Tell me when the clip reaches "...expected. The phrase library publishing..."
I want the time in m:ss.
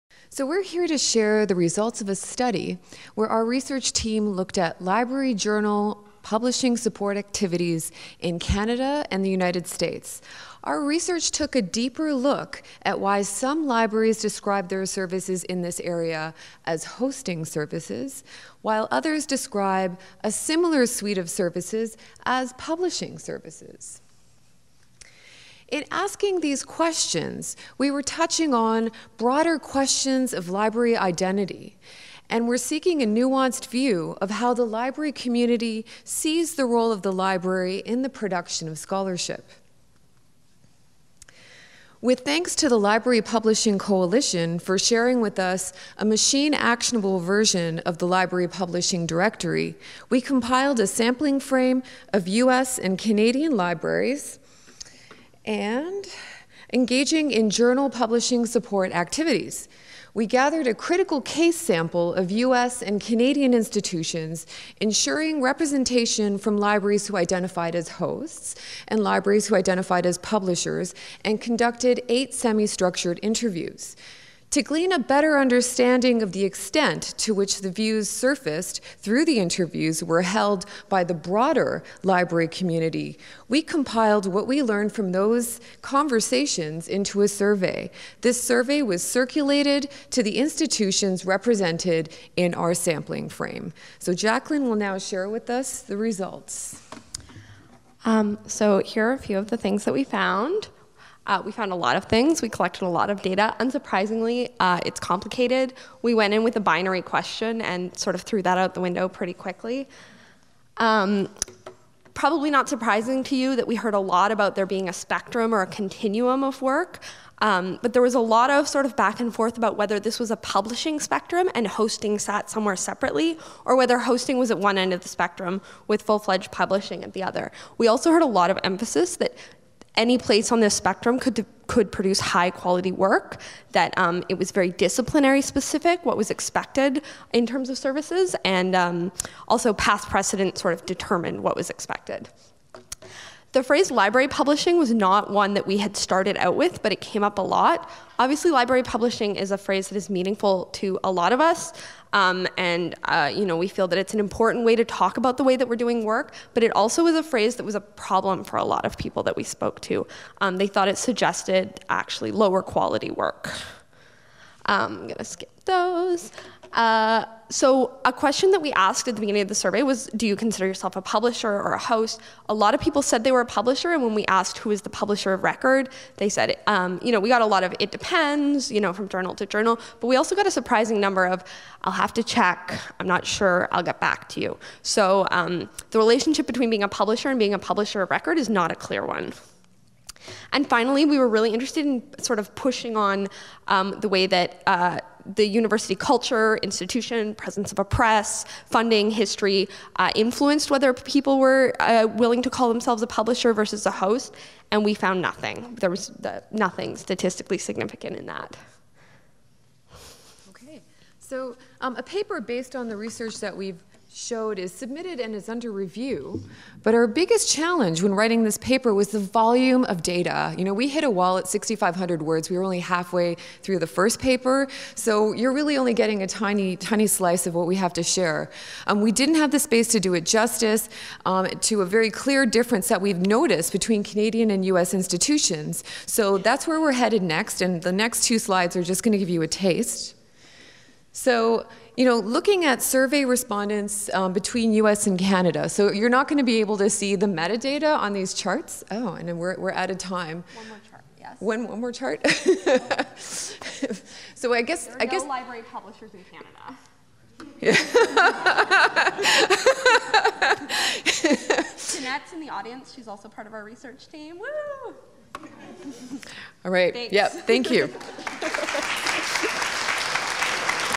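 2:21.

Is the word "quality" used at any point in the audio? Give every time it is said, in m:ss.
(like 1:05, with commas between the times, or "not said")
2:12, 2:42.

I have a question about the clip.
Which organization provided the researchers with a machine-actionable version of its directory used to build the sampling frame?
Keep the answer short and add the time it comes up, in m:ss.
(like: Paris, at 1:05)
Library Publishing Coalition, at 0:42.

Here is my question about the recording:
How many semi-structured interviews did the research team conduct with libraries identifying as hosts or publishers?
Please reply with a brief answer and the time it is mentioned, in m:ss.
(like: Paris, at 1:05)
8, at 1:12.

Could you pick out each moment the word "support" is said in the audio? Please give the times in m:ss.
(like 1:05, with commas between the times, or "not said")
0:06, 0:58.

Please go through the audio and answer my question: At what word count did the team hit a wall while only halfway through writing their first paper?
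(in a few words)
6,500.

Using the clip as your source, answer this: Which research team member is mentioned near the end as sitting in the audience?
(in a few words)
Jeanette.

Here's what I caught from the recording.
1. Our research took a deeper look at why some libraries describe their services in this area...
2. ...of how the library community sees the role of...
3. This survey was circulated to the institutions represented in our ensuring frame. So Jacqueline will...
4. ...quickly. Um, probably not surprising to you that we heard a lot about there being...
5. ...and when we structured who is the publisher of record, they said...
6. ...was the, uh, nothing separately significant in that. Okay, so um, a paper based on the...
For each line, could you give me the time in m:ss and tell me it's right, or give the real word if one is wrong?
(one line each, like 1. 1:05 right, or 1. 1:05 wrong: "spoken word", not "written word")
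1. 0:10 right
2. 0:34 right
3. 1:28 wrong: "sampling", not "ensuring"
4. 1:49 right
5. 2:53 wrong: "asked", not "structured"
6. 3:25 wrong: "statistically", not "separately".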